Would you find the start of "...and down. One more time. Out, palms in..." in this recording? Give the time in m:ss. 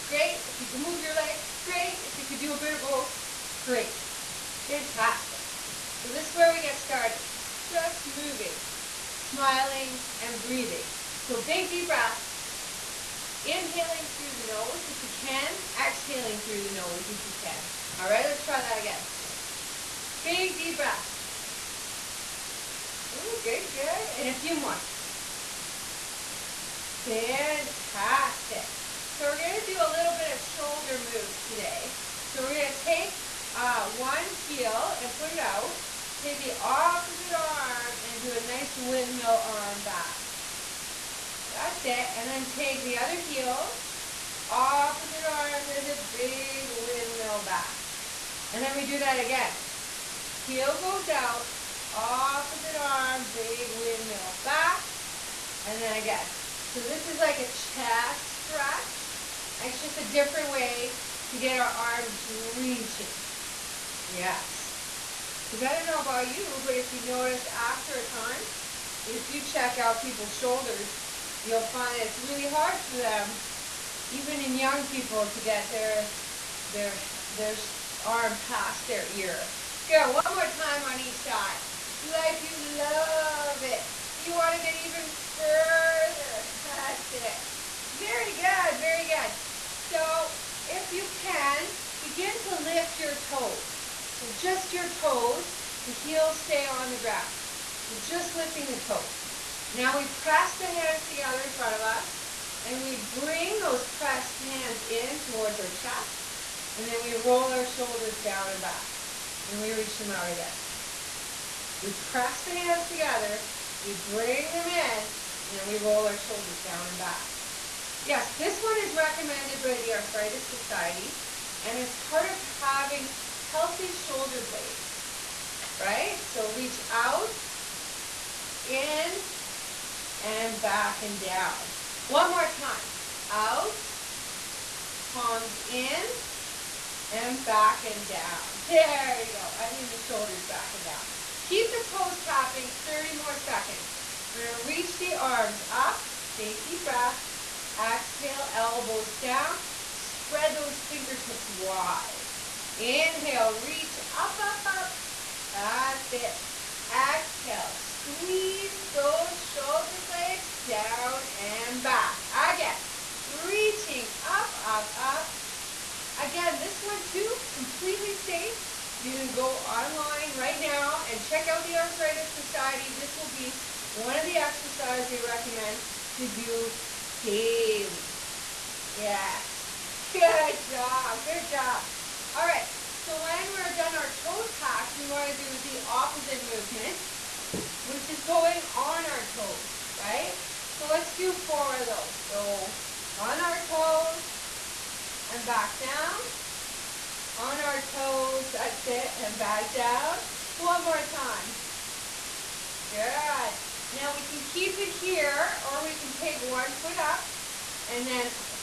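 2:11.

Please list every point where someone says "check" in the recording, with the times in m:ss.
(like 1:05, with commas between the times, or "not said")
1:09, 2:51.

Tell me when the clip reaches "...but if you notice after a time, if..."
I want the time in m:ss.
1:06.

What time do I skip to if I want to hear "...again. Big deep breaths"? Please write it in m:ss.
0:18.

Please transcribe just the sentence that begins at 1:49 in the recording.
Then we reach them out again.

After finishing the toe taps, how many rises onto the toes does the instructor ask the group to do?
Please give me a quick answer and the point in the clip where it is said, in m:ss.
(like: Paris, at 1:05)
4, at 3:11.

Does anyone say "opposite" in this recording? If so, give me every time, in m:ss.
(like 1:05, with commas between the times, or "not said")
0:36, 0:44, 0:51, 3:05.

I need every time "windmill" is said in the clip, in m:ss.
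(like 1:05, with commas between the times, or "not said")
0:38, 0:46, 0:53.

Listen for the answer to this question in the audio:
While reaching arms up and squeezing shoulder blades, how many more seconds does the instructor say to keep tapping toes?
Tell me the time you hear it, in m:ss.
2:22.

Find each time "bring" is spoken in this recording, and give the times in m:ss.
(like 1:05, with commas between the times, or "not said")
1:43, 1:53.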